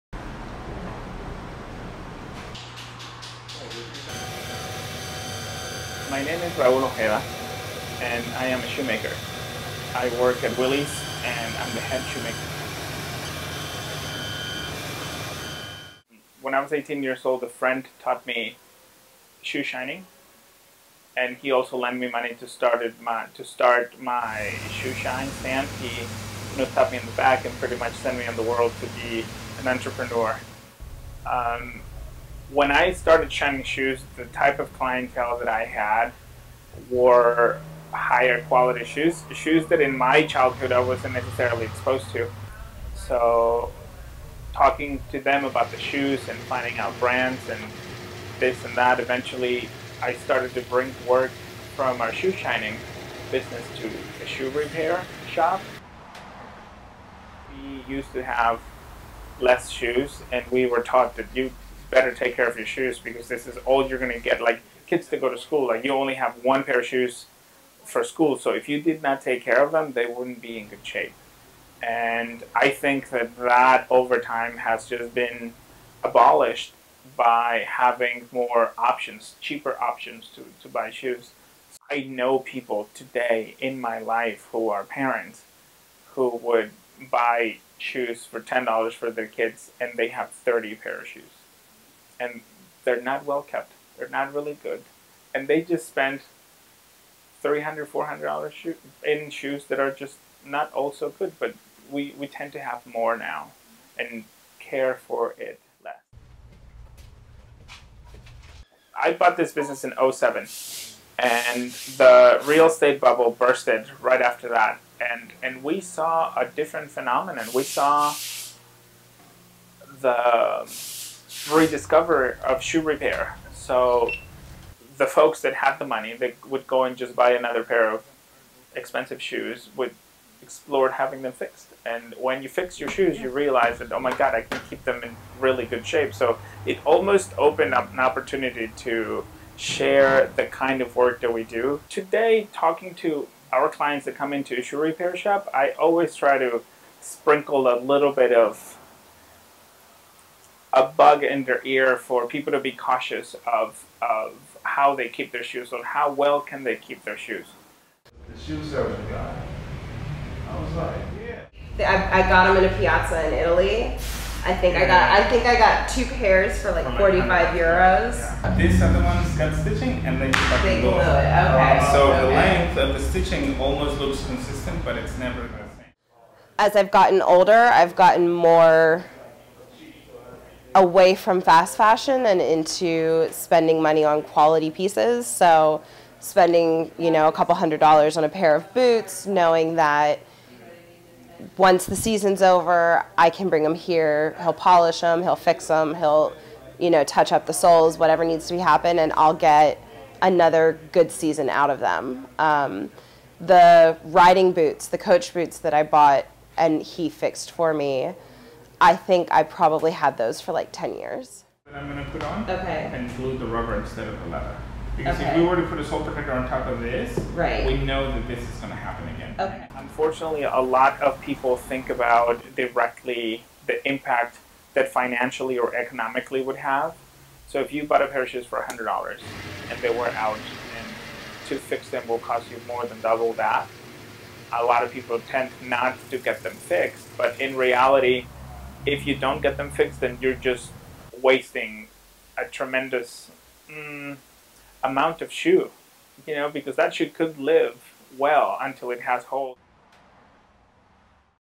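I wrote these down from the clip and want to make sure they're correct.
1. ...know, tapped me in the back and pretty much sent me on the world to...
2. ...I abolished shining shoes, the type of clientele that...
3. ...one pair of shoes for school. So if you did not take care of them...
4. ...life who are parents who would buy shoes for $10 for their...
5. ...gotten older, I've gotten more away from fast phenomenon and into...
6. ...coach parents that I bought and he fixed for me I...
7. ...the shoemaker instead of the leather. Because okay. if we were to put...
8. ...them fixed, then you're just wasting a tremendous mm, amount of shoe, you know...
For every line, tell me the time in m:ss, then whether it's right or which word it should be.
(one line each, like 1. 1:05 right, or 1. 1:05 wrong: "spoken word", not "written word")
1. 0:26 right
2. 0:32 wrong: "started", not "abolished"
3. 1:06 right
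4. 1:23 right
5. 2:56 wrong: "fashion", not "phenomenon"
6. 3:24 wrong: "boots", not "parents"
7. 3:33 wrong: "rubber", not "shoemaker"
8. 3:59 right.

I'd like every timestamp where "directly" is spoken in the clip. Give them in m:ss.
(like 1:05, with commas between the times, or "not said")
3:42.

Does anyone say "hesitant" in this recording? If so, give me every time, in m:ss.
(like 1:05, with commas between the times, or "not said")
not said.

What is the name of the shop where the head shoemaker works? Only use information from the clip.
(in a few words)
Willie's.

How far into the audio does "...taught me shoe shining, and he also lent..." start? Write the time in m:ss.
0:18.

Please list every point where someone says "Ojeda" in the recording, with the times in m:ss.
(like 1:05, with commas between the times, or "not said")
0:06.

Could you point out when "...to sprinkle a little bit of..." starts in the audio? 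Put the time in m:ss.
2:26.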